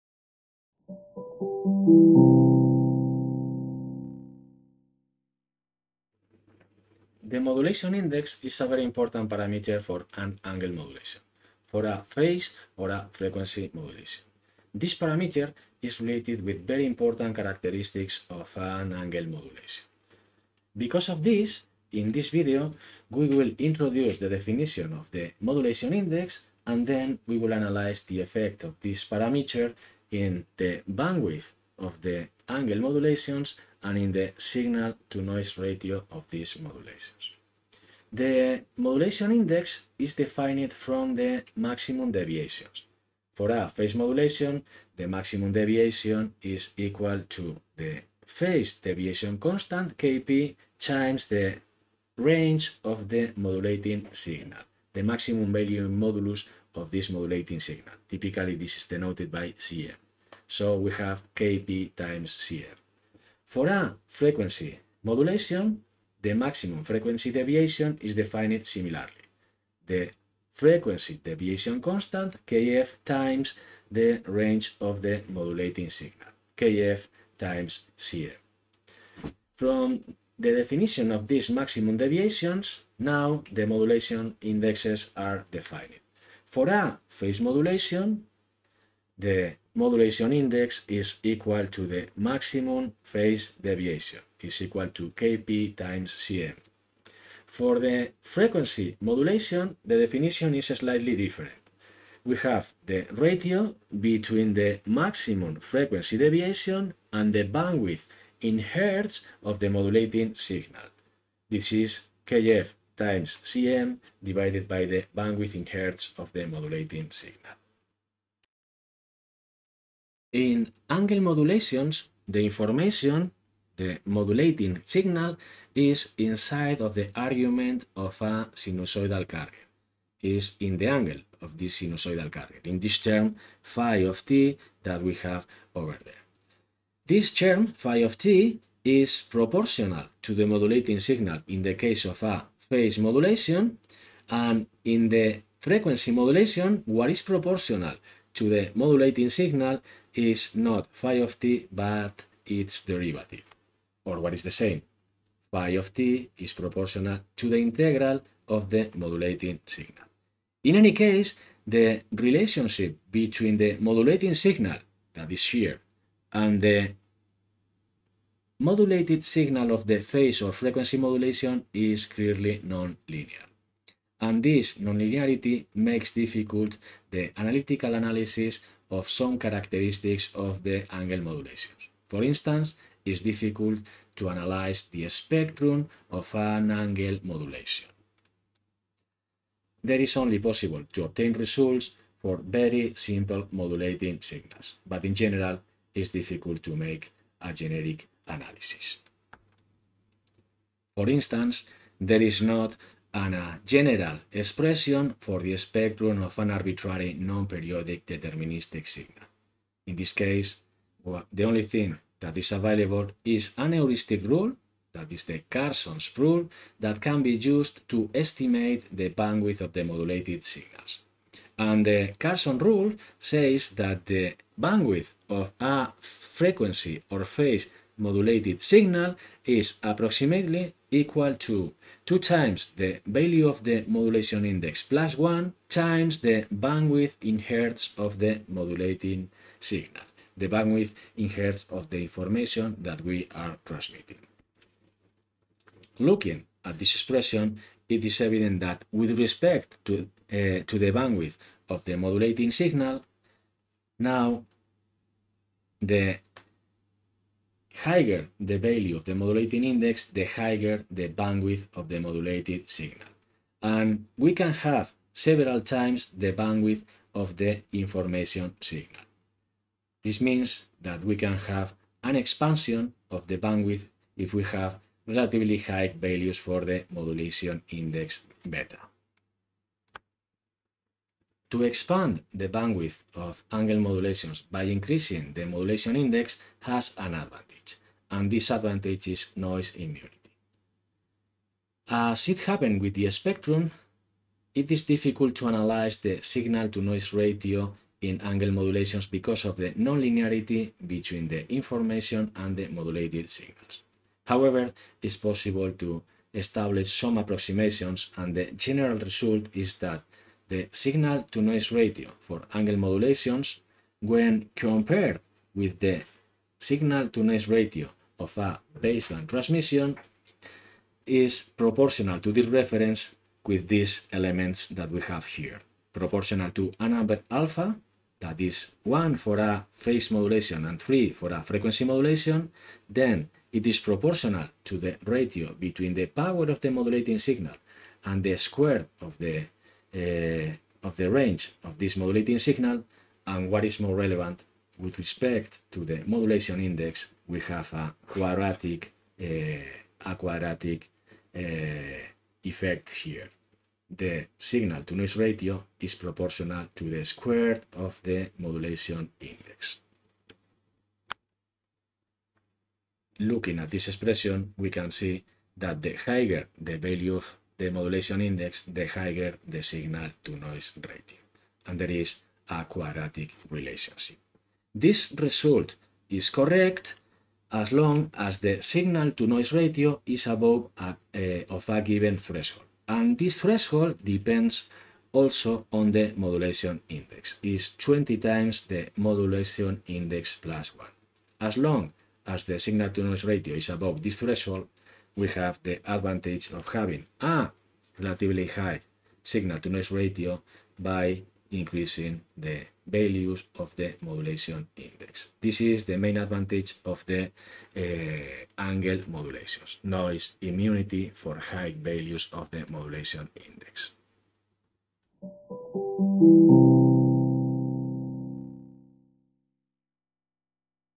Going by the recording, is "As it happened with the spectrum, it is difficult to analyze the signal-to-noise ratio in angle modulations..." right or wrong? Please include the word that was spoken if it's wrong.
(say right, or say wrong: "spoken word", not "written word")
right.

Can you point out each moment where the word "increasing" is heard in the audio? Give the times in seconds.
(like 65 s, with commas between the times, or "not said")
284 s, 401 s.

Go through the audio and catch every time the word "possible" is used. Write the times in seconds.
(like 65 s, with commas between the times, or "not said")
190 s, 305 s.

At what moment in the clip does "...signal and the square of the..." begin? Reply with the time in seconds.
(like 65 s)
337 s.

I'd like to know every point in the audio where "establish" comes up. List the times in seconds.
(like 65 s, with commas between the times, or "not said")
306 s.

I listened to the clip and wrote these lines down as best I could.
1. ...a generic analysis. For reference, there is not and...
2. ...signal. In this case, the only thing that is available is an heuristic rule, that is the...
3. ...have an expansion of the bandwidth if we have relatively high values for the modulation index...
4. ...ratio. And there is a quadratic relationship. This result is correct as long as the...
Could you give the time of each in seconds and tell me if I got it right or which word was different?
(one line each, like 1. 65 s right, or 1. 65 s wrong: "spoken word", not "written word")
1. 197 s wrong: "instance", not "reference"
2. 208 s right
3. 271 s right
4. 370 s right.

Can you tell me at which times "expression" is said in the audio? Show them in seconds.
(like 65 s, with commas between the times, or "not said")
204 s, 246 s, 363 s.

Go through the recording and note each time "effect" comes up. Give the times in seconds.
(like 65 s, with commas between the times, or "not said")
28 s, 352 s.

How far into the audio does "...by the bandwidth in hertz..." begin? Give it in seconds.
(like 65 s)
114 s.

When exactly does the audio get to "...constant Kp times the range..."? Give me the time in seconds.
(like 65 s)
49 s.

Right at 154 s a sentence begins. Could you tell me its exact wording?
Or what is the same, phi of t is proportional to the integral of the modulating signal.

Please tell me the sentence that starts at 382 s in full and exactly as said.
And this threshold depends also on the modulation index, is 20 times the modulation index plus 1.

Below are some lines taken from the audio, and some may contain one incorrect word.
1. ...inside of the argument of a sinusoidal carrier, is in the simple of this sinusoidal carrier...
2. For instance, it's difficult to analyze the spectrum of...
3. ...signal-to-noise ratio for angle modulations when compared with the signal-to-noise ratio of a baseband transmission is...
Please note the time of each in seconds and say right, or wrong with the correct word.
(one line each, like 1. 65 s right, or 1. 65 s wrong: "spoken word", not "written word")
1. 126 s wrong: "angle", not "simple"
2. 182 s right
3. 310 s right.